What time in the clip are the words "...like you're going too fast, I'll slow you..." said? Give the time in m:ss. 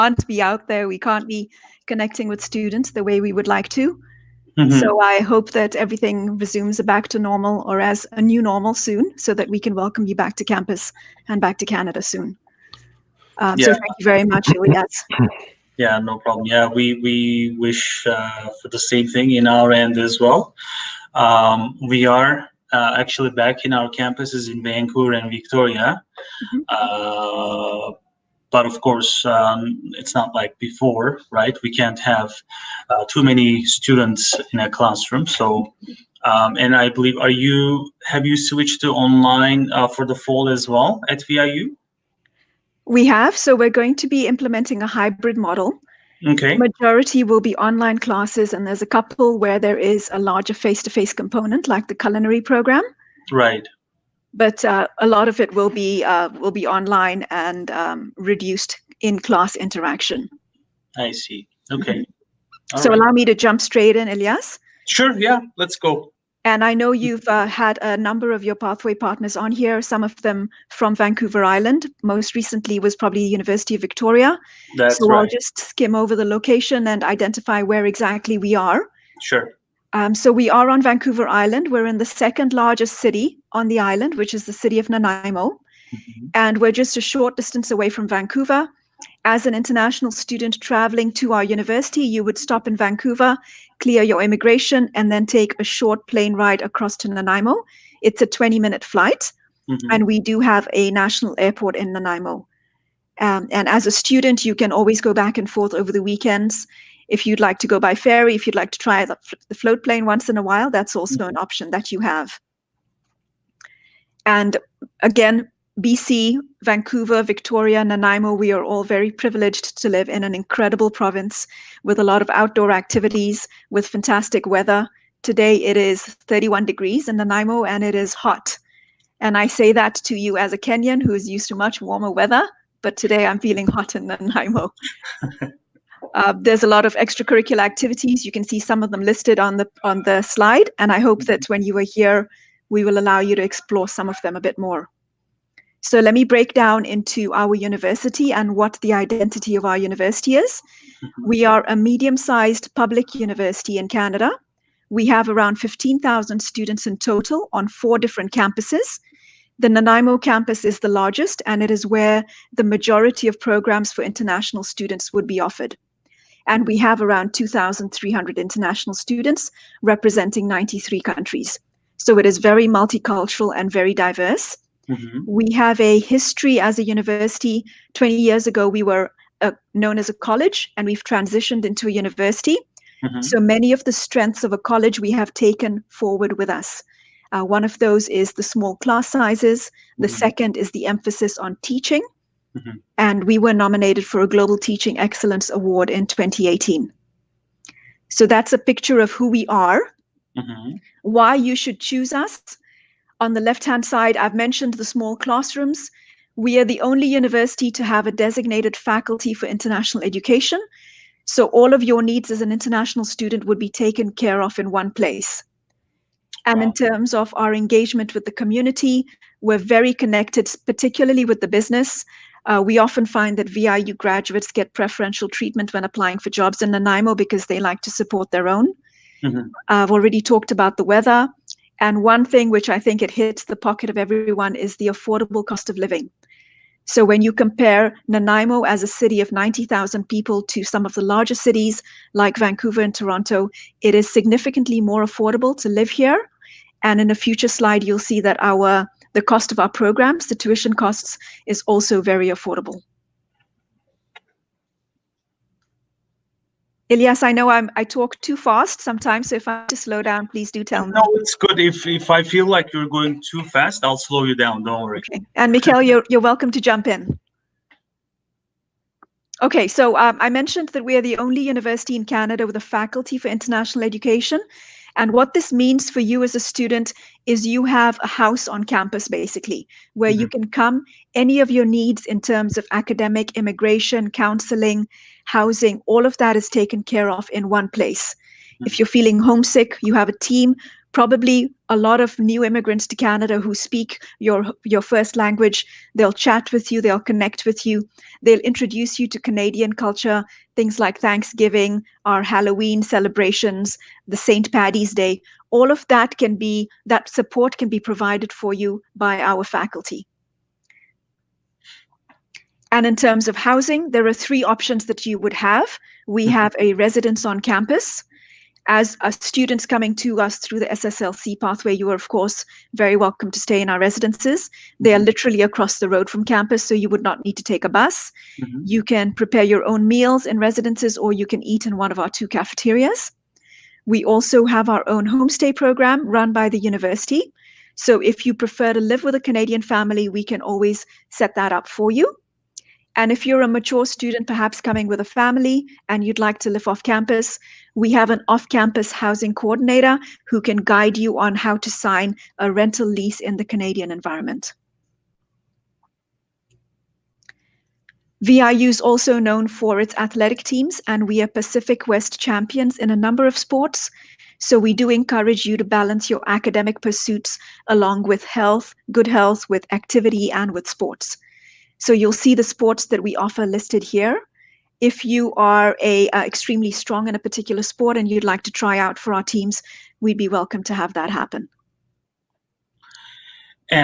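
4:22.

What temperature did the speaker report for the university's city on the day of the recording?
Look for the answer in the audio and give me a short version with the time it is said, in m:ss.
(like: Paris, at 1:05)
31 degrees, at 2:06.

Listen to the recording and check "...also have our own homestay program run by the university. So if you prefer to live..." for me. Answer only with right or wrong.
right.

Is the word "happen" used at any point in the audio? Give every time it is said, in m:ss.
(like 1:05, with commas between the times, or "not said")
6:21.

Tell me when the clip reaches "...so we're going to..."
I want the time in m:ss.
0:43.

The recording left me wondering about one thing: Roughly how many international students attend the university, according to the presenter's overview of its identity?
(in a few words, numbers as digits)
2,300.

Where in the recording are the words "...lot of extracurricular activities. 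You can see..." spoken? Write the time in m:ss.
2:16.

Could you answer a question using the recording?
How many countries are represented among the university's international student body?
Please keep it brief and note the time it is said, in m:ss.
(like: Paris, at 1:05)
93, at 2:50.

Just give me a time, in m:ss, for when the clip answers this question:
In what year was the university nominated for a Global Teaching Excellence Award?
3:16.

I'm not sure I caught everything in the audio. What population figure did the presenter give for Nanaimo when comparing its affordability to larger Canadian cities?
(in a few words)
90,000.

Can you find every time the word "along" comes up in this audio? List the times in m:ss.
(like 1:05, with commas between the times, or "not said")
6:07.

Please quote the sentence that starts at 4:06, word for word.
And in a future slide, you'll see that our the cost of our programs, the tuition costs, is also very affordable.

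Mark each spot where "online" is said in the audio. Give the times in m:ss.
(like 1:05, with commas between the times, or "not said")
0:39, 0:47, 0:56.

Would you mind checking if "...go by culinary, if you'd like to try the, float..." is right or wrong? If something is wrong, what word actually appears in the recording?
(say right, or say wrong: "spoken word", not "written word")
wrong: "ferry", not "culinary".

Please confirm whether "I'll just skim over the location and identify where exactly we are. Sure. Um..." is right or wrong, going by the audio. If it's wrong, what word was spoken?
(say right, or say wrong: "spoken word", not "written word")
right.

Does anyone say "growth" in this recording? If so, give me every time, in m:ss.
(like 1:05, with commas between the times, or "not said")
not said.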